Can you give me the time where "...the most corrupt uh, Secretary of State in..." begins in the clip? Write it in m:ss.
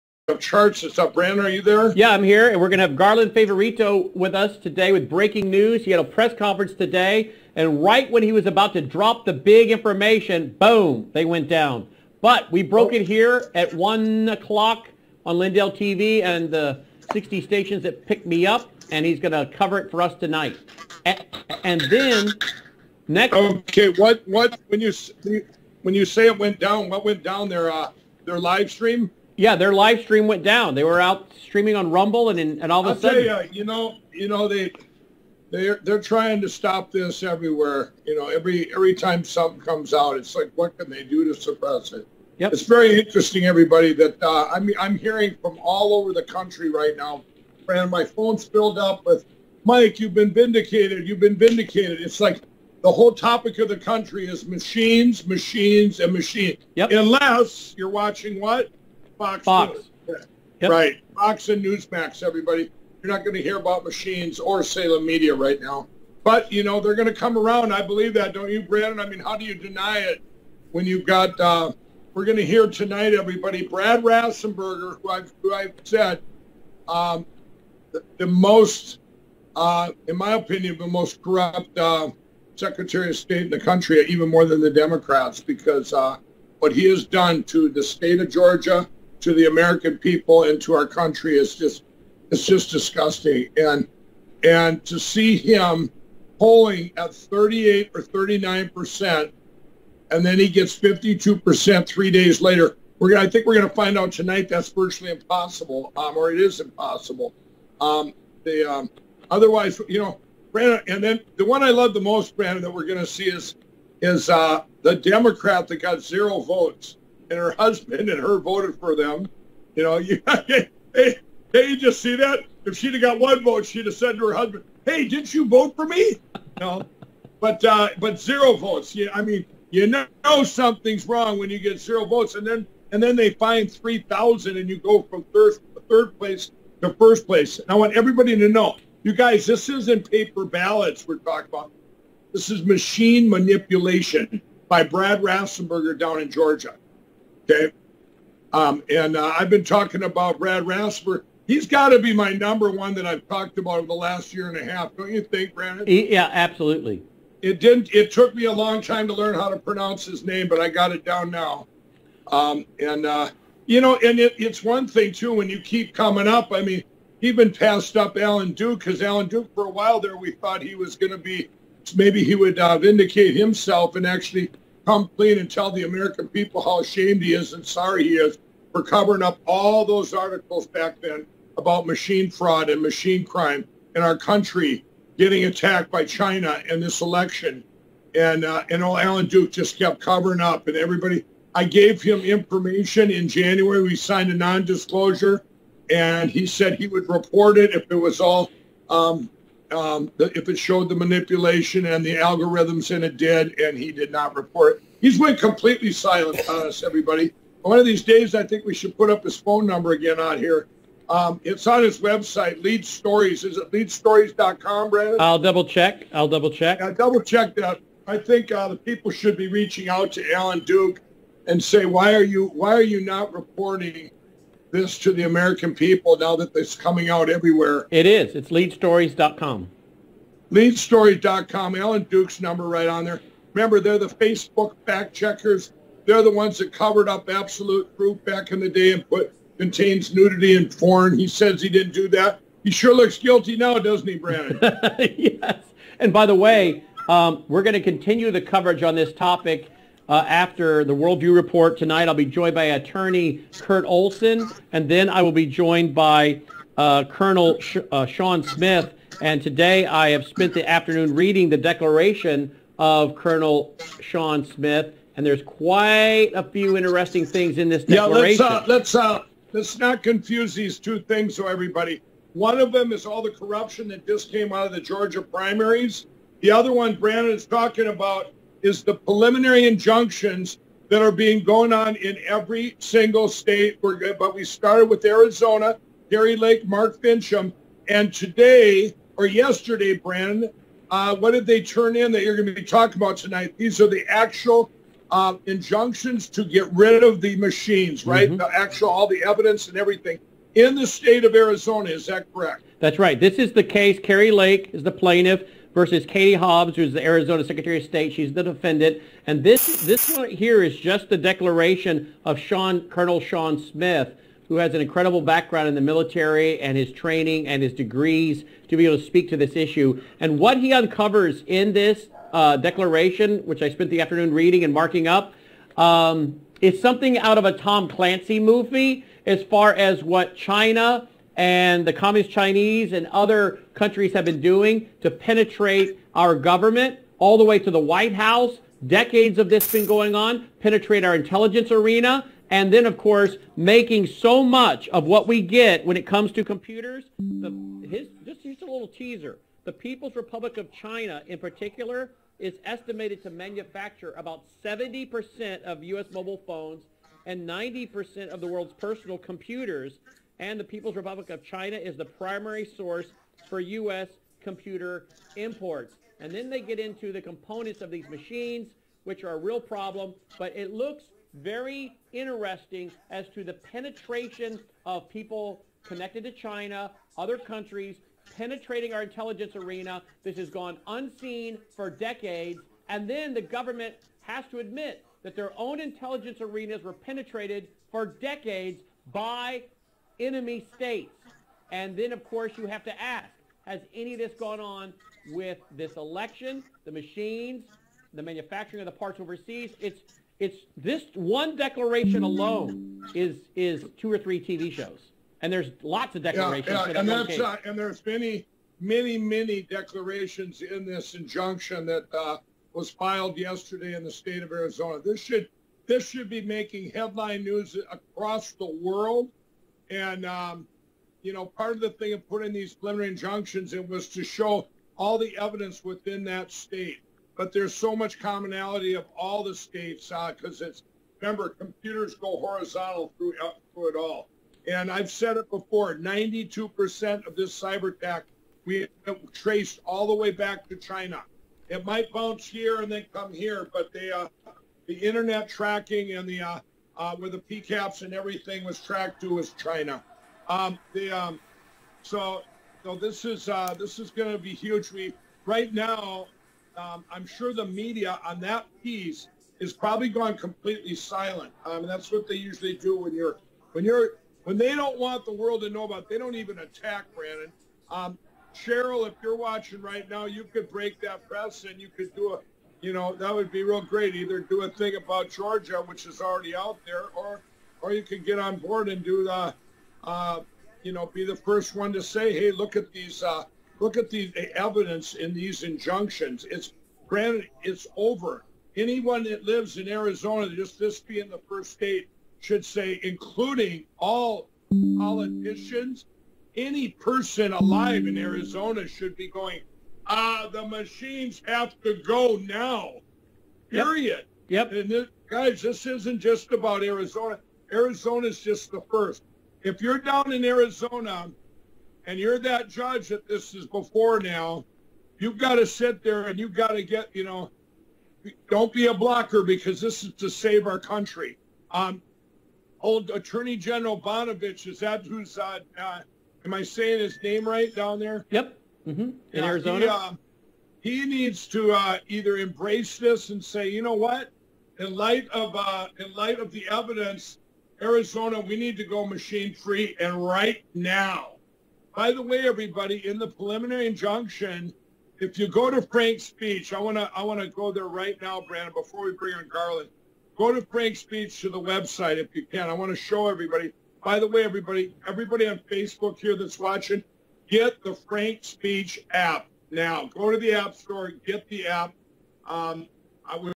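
1:20.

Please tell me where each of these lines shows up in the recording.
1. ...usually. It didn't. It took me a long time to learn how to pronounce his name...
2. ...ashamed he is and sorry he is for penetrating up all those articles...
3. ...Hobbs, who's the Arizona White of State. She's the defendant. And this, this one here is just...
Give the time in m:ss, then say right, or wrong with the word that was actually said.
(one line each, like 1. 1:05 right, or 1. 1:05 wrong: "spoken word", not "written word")
1. 2:36 wrong: "absolutely", not "usually"
2. 2:56 wrong: "covering", not "penetrating"
3. 5:06 wrong: "Secretary", not "White".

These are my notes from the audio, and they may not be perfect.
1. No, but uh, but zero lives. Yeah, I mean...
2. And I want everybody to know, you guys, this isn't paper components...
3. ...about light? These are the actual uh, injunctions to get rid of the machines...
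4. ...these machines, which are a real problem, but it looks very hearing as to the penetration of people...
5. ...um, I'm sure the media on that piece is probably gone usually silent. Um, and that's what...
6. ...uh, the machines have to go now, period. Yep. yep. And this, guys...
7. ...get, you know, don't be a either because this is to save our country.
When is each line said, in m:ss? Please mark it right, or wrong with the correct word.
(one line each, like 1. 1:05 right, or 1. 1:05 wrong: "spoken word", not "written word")
1. 2:06 wrong: "votes", not "lives"
2. 2:17 wrong: "ballots", not "components"
3. 4:53 wrong: "tonight", not "light"
4. 6:07 wrong: "interesting", not "hearing"
5. 7:36 wrong: "completely", not "usually"
6. 8:20 right
7. 8:36 wrong: "blocker", not "either".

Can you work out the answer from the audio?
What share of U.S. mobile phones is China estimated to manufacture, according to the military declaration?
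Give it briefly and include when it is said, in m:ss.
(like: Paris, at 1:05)
70%, at 5:54.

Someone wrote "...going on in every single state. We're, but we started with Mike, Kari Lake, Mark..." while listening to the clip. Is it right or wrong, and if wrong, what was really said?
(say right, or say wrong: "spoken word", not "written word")
wrong: "Arizona", not "Mike".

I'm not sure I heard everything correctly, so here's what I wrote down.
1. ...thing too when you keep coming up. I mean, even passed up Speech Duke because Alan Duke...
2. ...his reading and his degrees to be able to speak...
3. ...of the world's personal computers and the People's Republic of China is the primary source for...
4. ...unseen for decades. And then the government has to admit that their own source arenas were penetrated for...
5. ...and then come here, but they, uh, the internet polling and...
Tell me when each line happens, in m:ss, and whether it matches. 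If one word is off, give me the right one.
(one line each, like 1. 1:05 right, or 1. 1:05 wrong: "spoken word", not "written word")
1. 2:44 wrong: "Alan", not "Speech"
2. 5:16 wrong: "training", not "reading"
3. 5:58 right
4. 6:20 wrong: "intelligence", not "source"
5. 7:22 wrong: "tracking", not "polling".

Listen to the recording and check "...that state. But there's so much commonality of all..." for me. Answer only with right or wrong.
right.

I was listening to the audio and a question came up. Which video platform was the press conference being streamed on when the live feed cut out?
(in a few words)
Rumble.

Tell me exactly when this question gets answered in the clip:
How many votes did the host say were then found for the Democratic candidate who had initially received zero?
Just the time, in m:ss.
2:13.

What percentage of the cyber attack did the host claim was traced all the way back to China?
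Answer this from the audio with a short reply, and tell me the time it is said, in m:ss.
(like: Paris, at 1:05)
92%, at 7:15.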